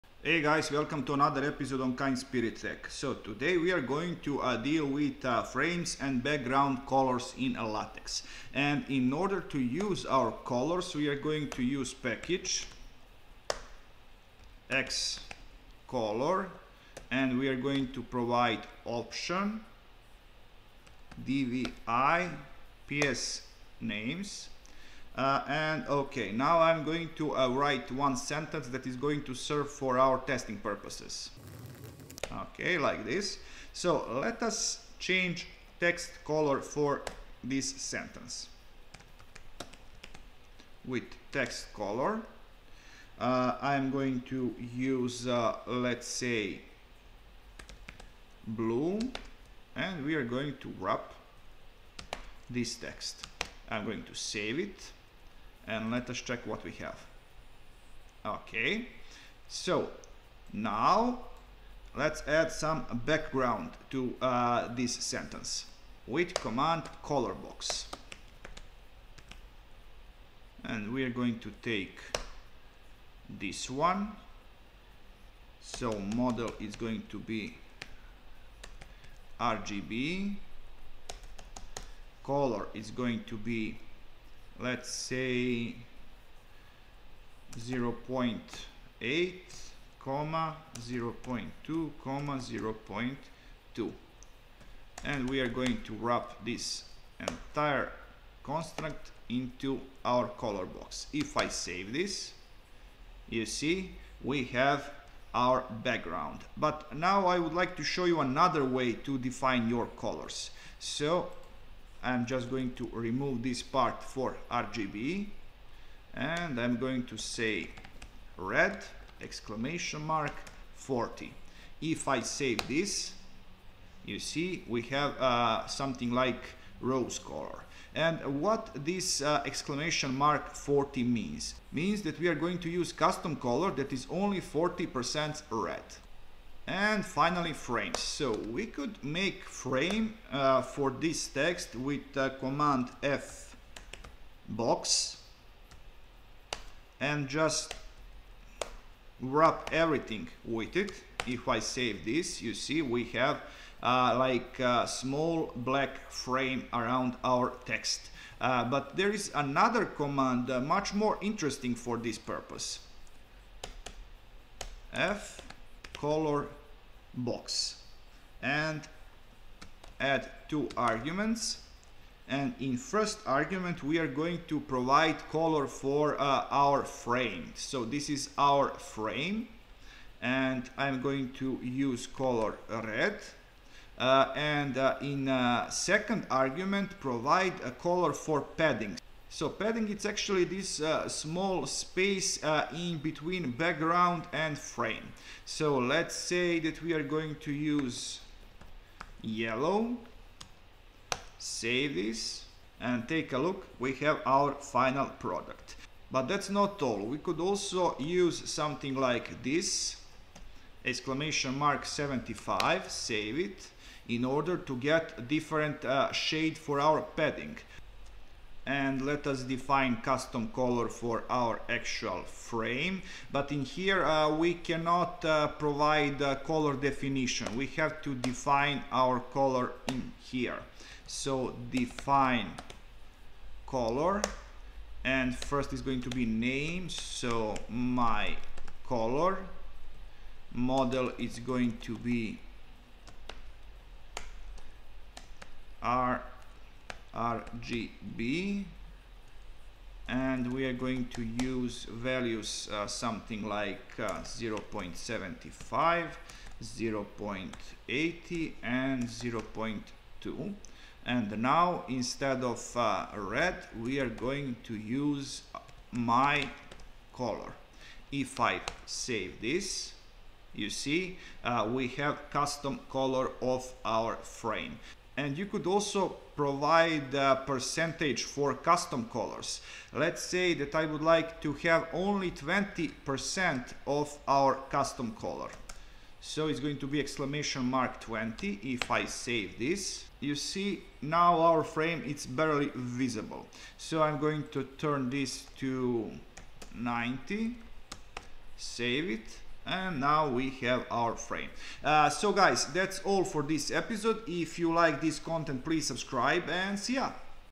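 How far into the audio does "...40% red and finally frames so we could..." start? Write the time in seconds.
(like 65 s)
134 s.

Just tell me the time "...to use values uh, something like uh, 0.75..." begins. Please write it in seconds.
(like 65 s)
251 s.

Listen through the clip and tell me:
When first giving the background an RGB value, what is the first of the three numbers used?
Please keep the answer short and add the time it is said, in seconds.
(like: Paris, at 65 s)
0.8, at 87 s.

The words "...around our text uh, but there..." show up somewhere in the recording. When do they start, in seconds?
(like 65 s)
156 s.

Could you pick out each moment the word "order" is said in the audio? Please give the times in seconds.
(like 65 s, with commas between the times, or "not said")
9 s, 214 s.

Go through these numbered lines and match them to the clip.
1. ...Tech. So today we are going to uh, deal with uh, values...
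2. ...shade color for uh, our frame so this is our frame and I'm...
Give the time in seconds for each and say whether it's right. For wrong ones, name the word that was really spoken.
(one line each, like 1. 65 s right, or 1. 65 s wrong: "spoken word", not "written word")
1. 2 s wrong: "frames", not "values"
2. 174 s wrong: "provide", not "shade".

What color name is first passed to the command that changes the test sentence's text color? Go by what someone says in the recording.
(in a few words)
blue.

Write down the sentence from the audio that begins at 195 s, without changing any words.
So let's say that we are going to use yellow, save this and take a look, we have our final product.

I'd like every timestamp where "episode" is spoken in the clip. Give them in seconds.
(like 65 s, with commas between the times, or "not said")
1 s, 303 s.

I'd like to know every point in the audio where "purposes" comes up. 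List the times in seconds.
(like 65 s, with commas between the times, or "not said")
30 s, 162 s.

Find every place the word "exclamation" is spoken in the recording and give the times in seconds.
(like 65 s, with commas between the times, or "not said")
119 s, 129 s, 210 s, 286 s.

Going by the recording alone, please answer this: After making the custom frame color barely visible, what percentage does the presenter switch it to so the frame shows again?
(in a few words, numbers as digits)
90.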